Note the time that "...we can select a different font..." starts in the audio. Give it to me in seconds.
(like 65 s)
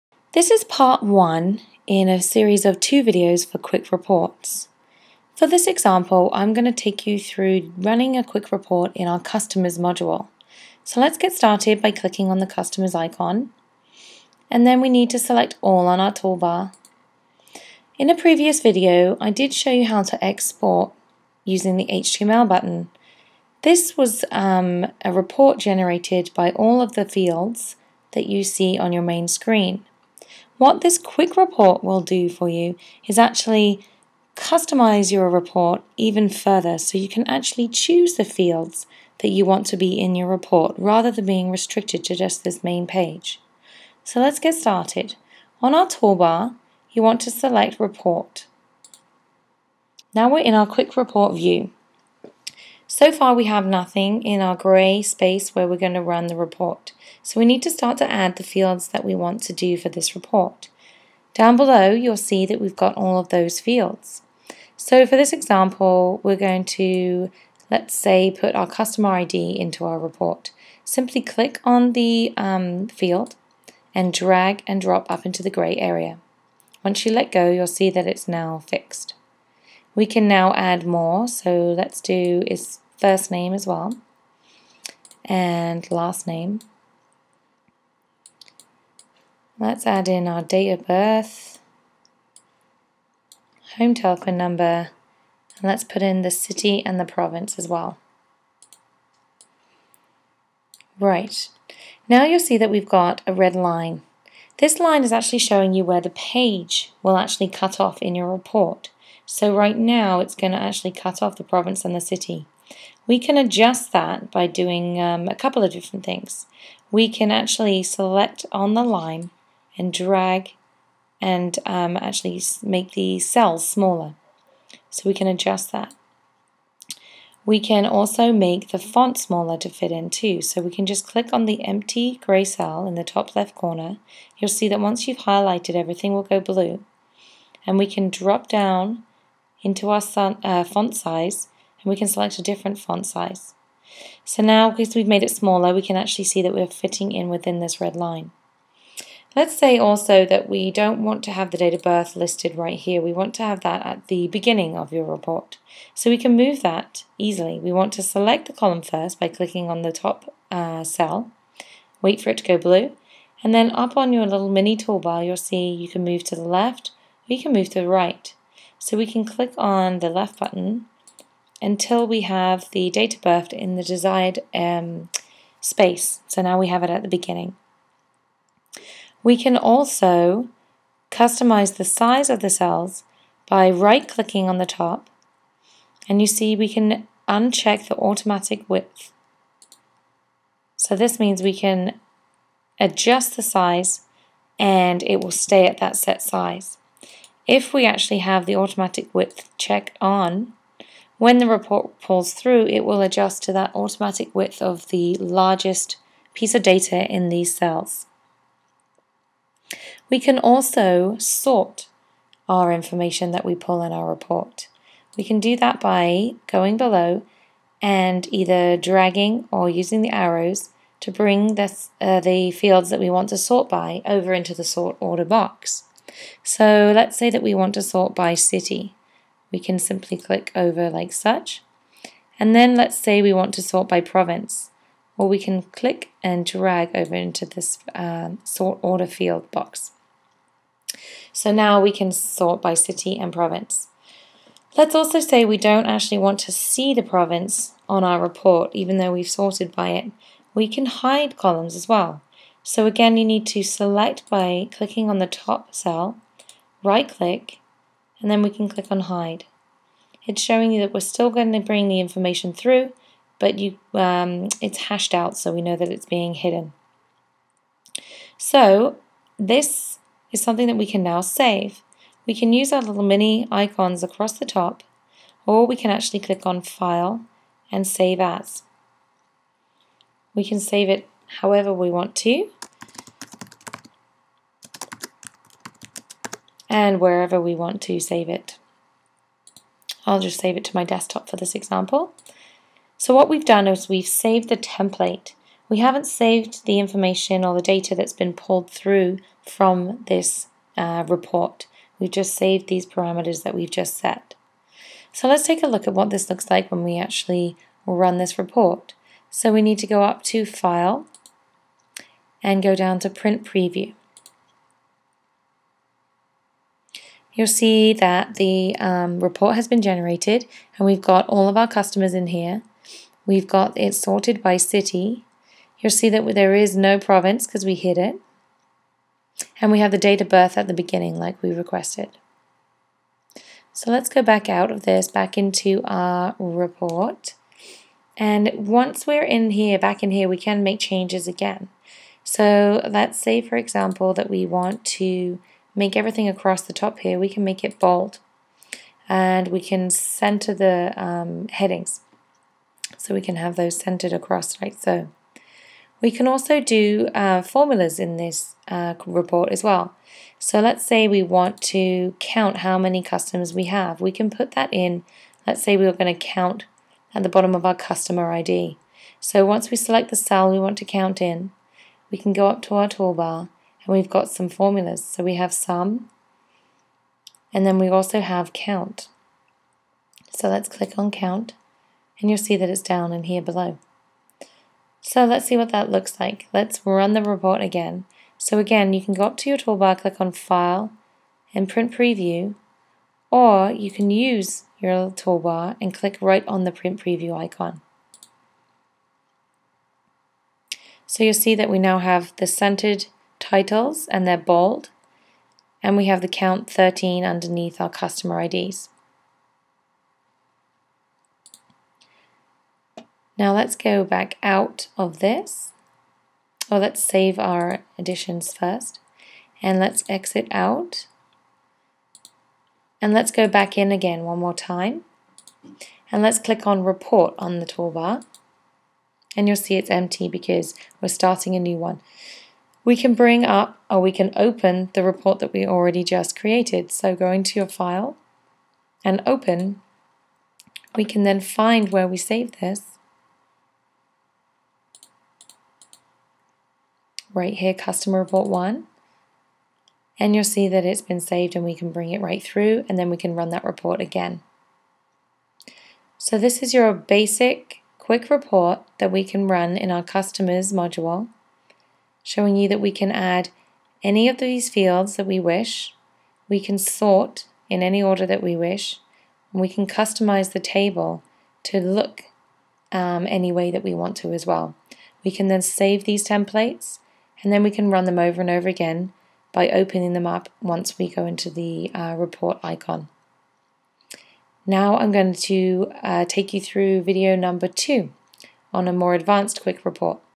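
141 s.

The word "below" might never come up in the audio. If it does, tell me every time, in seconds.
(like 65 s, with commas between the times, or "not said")
61 s, 216 s, 383 s.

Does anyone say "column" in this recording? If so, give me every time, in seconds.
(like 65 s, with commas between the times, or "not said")
158 s, 251 s.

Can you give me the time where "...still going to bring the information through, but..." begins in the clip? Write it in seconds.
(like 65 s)
260 s.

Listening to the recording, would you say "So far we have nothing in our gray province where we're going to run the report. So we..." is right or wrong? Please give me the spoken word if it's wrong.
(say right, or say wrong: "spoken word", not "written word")
wrong: "space", not "province".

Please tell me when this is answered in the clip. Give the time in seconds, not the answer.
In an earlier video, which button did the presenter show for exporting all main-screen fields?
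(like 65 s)
21 s.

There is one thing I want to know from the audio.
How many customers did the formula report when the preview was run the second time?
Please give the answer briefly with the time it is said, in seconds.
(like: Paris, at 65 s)
13, at 406 s.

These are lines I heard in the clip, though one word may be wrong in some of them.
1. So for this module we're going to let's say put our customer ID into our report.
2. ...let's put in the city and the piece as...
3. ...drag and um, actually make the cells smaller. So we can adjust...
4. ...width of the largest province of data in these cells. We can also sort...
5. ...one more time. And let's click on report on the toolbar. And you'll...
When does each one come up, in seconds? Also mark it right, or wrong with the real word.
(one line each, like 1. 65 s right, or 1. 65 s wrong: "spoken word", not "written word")
1. 64 s wrong: "example", not "module"
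2. 95 s wrong: "province", not "piece"
3. 119 s right
4. 204 s wrong: "piece", not "province"
5. 424 s right.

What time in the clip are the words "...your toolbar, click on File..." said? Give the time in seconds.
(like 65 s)
389 s.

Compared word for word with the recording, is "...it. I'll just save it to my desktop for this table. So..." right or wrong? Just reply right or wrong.
wrong.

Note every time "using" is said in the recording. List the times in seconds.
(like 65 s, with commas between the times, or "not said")
21 s, 219 s.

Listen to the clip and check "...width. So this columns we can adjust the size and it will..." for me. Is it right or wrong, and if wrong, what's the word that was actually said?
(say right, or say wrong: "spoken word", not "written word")
wrong: "means", not "columns".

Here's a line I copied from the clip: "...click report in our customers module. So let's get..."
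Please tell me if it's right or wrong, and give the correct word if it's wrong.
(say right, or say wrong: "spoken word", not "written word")
wrong: "quick", not "click".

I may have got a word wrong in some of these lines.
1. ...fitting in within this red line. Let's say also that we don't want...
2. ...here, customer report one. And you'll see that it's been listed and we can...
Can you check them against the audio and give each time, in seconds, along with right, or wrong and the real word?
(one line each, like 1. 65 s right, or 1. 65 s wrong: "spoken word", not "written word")
1. 146 s right
2. 447 s wrong: "saved", not "listed".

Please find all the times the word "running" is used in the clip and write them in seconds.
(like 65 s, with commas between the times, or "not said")
7 s.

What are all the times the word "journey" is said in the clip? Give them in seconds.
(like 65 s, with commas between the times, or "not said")
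not said.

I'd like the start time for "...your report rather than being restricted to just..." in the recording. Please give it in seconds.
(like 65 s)
40 s.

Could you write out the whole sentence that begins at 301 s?
We've just saved these parameters that we've just set.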